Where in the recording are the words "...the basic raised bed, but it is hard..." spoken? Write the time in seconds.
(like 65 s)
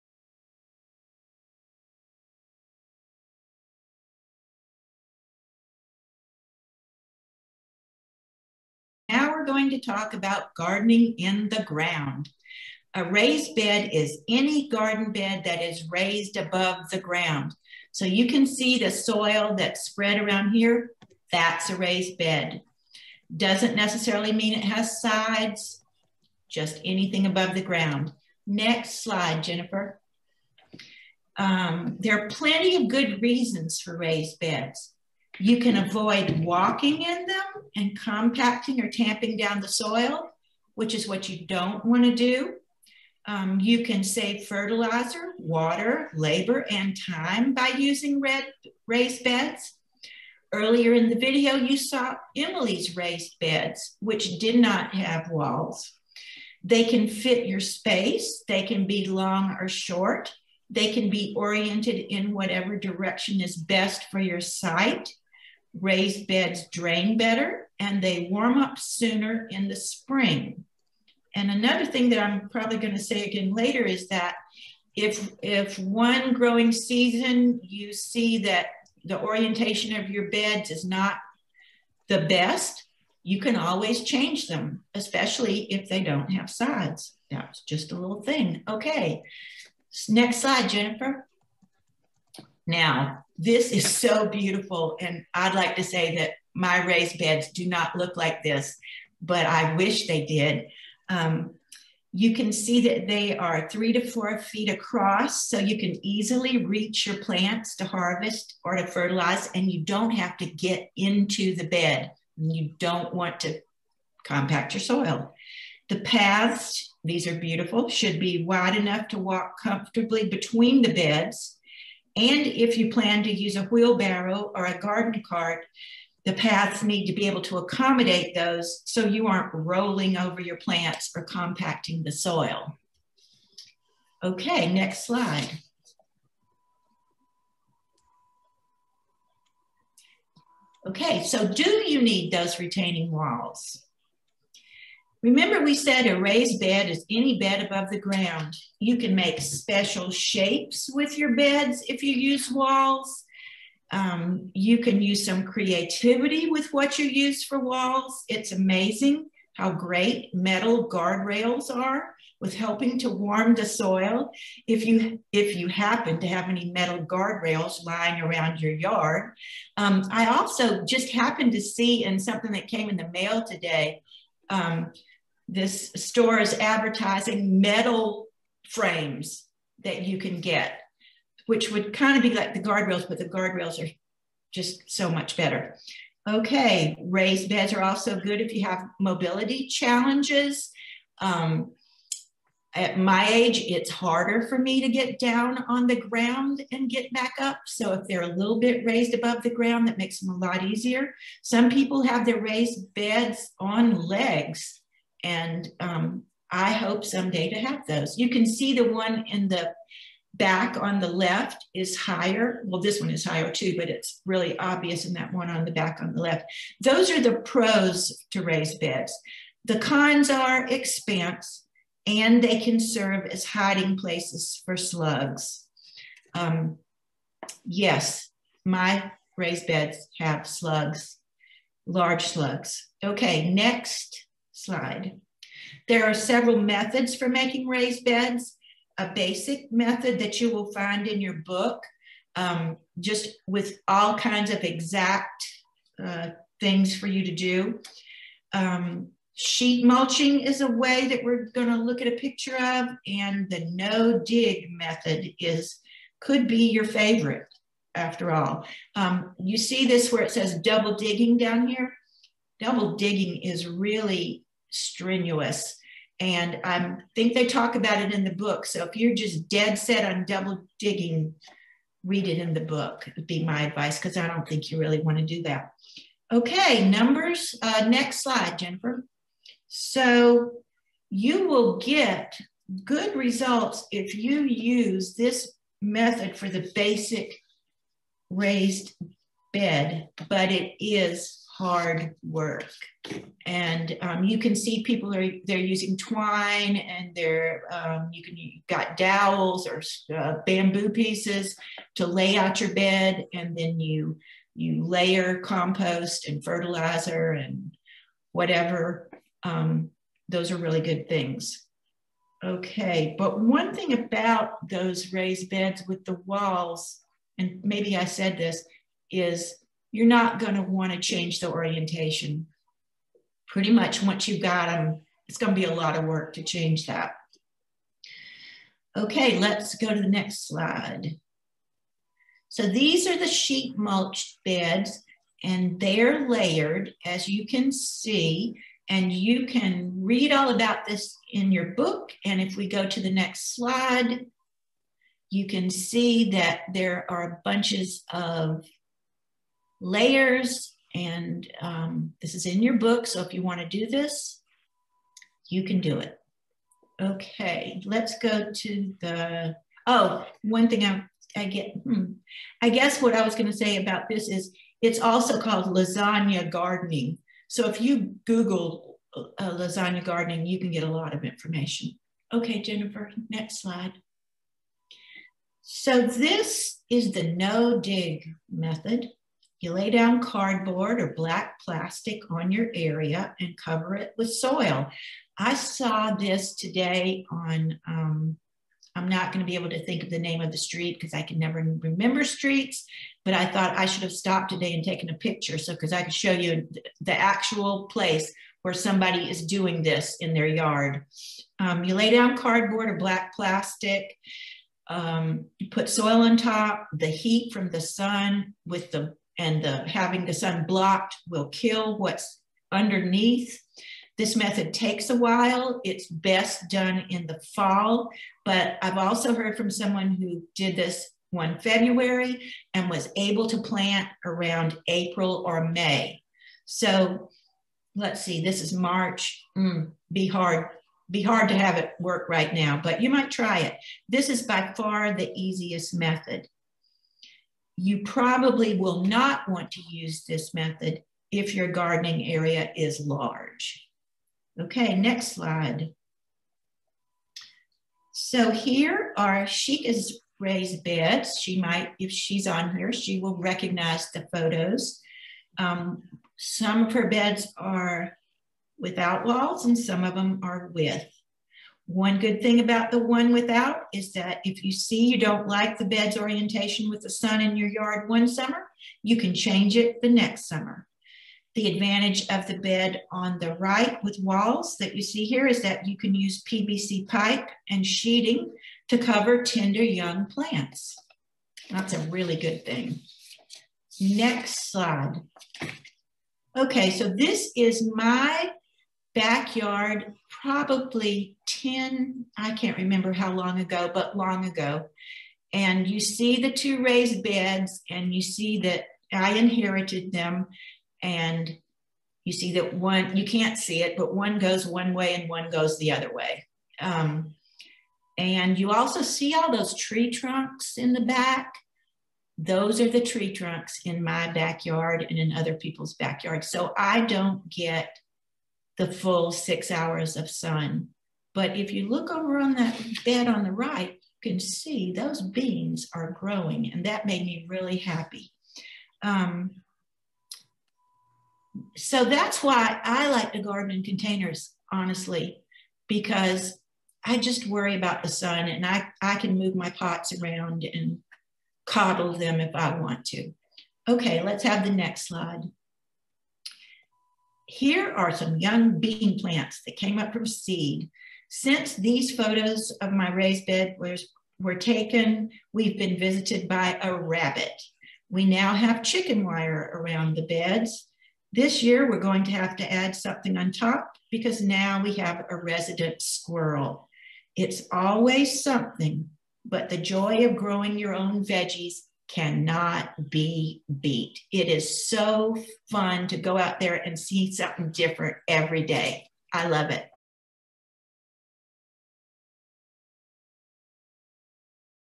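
286 s.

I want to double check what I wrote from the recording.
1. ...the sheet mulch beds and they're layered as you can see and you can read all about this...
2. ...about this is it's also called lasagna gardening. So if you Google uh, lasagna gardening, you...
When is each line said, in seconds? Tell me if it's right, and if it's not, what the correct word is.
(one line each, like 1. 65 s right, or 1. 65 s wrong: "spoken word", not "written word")
1. 333 s right
2. 363 s right.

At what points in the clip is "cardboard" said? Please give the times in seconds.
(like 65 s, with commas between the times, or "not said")
380 s, 402 s.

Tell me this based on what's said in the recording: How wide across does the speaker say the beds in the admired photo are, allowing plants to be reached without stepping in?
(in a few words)
3 to 4 feet.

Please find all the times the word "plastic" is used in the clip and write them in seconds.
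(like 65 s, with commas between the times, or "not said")
381 s, 403 s.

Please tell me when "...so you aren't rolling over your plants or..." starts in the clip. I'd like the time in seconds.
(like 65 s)
128 s.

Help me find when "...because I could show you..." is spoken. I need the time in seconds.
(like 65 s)
395 s.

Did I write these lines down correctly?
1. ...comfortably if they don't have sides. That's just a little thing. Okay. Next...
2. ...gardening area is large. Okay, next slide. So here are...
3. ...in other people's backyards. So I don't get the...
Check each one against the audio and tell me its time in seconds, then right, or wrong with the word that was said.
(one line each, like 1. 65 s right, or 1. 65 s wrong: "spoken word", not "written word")
1. 84 s wrong: "especially", not "comfortably"
2. 441 s right
3. 515 s right.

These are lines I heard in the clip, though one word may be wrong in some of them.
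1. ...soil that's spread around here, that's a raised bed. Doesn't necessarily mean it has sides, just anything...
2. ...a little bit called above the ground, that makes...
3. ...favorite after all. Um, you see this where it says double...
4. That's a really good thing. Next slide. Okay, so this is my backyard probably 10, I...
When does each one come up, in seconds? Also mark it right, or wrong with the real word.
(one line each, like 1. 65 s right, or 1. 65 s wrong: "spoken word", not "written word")
1. 18 s right
2. 198 s wrong: "raised", not "called"
3. 256 s right
4. 481 s right.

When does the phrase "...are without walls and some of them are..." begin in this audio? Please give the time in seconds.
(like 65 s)
457 s.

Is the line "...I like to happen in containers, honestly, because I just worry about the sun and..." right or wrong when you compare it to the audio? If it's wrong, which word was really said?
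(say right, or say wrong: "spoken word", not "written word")
wrong: "garden", not "happen".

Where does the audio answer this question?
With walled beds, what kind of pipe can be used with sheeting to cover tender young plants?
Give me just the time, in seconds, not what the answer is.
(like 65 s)
476 s.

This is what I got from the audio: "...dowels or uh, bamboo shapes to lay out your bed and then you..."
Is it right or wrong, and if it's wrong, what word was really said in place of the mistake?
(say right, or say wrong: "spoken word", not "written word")
wrong: "pieces", not "shapes".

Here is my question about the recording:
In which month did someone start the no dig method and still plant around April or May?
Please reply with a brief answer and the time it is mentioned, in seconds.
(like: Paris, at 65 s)
February, at 421 s.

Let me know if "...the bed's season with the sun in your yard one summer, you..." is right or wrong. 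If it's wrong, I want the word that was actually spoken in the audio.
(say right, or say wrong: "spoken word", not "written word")
wrong: "orientation", not "season".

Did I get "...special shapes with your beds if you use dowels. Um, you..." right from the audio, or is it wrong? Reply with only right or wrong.
wrong.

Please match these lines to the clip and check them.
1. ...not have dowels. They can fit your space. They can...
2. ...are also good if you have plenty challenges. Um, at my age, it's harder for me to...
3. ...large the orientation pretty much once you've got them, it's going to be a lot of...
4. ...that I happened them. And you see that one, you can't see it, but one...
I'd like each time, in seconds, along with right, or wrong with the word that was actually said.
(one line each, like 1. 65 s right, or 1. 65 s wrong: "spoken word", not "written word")
1. 54 s wrong: "walls", not "dowels"
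2. 187 s wrong: "mobility", not "plenty"
3. 320 s wrong: "change", not "large"
4. 498 s wrong: "inherited", not "happened".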